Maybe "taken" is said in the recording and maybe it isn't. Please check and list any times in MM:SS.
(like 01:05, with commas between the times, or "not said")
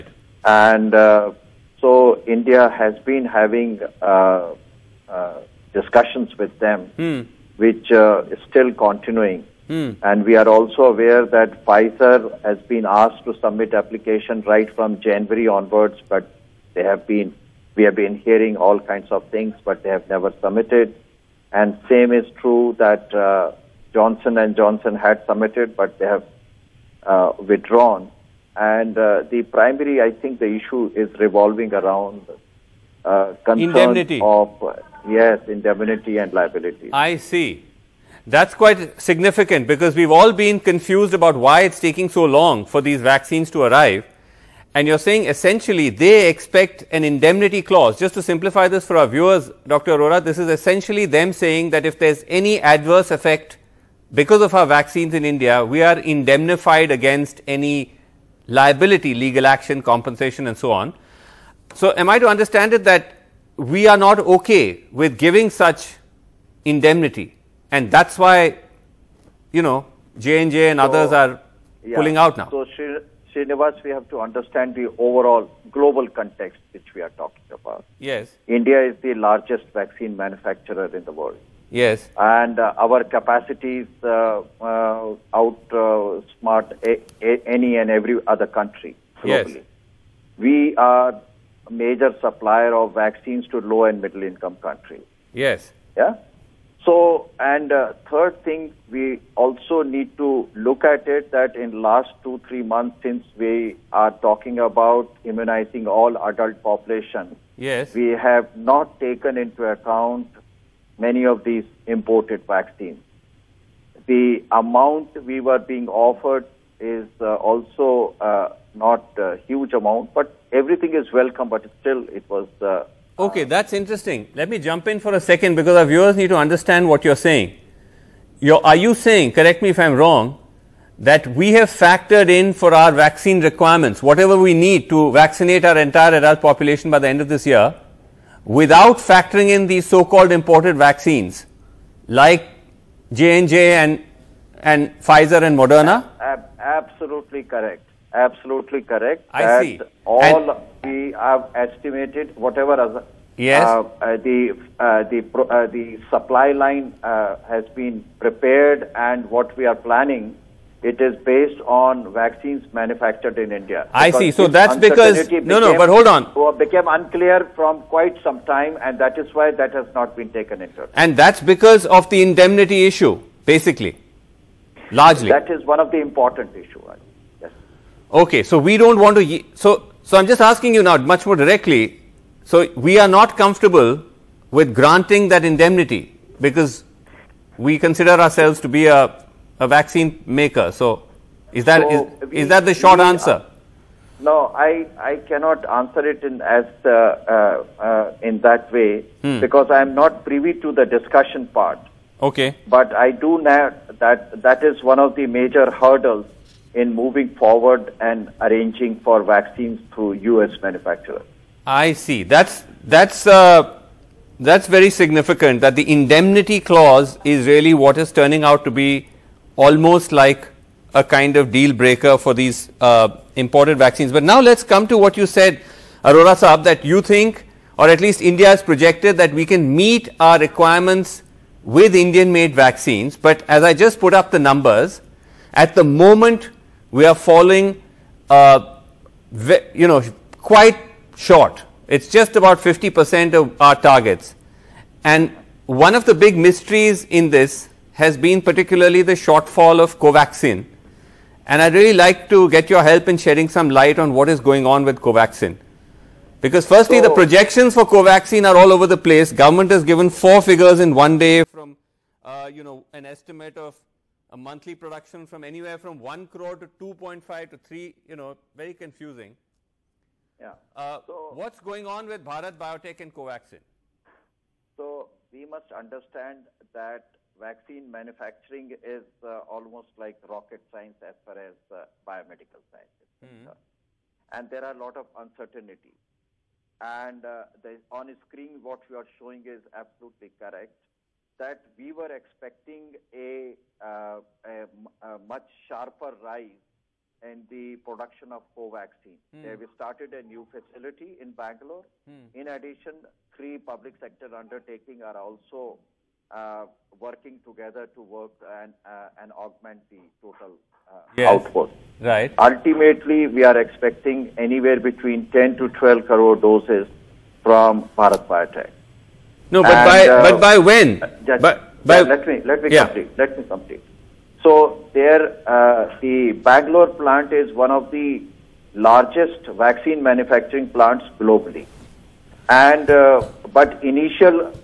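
01:49, 02:50.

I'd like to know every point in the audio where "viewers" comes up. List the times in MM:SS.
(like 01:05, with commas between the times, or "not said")
00:49, 02:05.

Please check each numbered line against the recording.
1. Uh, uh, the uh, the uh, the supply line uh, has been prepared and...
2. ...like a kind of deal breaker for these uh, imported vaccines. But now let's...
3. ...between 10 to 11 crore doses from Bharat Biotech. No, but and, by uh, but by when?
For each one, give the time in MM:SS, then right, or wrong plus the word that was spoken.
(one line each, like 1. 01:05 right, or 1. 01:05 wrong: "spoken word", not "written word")
1. 02:33 right
2. 03:40 right
3. 05:14 wrong: "12", not "11".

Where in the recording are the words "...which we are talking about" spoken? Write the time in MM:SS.
01:16.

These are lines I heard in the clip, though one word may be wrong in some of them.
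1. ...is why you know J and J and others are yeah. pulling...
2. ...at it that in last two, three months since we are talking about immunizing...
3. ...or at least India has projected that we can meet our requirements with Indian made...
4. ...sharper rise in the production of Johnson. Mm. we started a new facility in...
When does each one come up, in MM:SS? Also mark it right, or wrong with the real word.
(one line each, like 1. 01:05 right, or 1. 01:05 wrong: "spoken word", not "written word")
1. 01:08 right
2. 01:40 right
3. 03:47 right
4. 04:55 wrong: "Covaxin", not "Johnson".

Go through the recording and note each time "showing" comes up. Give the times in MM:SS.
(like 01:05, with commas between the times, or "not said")
04:49.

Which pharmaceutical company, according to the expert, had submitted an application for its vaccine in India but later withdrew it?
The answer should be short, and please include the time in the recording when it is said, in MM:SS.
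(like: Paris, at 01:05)
Johnson and Johnson, at 00:23.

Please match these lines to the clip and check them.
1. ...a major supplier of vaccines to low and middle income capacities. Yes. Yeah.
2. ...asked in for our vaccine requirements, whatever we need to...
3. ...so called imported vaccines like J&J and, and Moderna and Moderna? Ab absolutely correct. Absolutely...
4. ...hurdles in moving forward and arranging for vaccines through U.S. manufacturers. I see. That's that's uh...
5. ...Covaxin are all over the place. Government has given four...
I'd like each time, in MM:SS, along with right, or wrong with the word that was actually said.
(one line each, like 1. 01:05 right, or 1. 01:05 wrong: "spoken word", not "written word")
1. 01:31 wrong: "countries", not "capacities"
2. 02:11 wrong: "factored", not "asked"
3. 02:19 wrong: "Pfizer", not "Moderna"
4. 03:25 right
5. 04:17 right.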